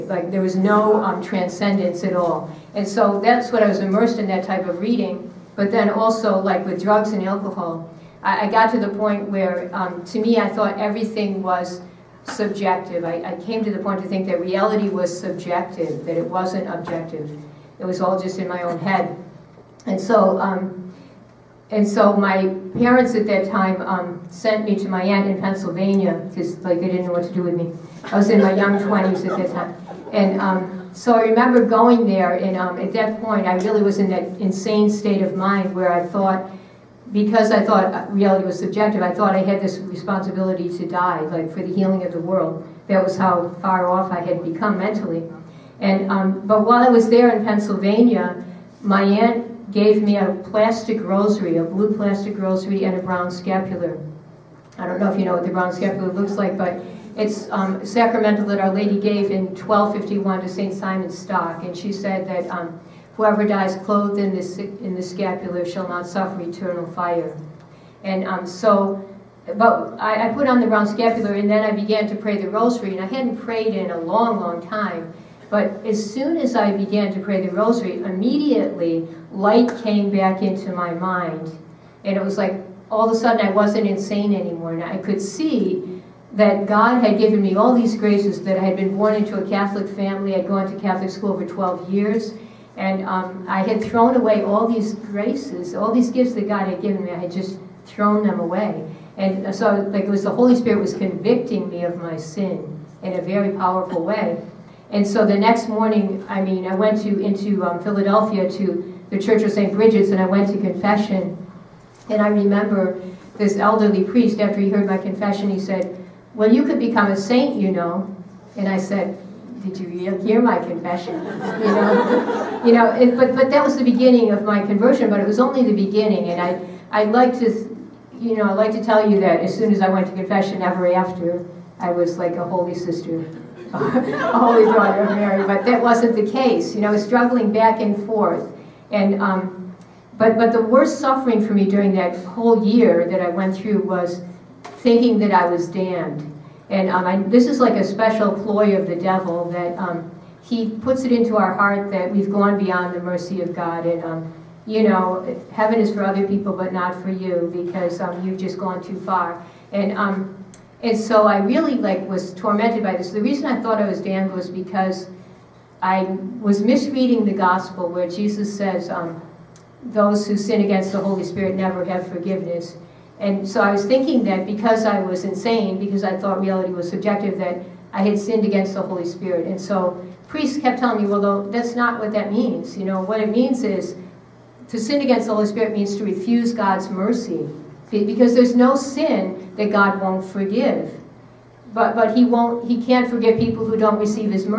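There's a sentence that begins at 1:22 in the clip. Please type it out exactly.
And it was like all of a sudden I wasn't insane anymore.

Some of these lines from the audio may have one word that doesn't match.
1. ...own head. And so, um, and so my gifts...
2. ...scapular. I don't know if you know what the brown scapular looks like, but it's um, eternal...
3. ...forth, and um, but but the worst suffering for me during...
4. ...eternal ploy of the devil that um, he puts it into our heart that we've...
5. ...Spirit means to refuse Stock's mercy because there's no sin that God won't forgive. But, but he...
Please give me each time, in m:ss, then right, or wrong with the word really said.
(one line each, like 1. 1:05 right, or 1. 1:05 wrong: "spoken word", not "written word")
1. 0:18 wrong: "parents", not "gifts"
2. 0:53 wrong: "sacramental", not "eternal"
3. 2:18 right
4. 2:27 wrong: "special", not "eternal"
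5. 3:05 wrong: "God", not "Stock".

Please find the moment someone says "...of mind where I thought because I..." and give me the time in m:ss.
0:35.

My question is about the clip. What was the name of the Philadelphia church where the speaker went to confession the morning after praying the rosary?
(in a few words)
St. Bridget's.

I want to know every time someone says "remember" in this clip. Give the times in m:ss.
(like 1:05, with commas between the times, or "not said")
0:31, 1:52.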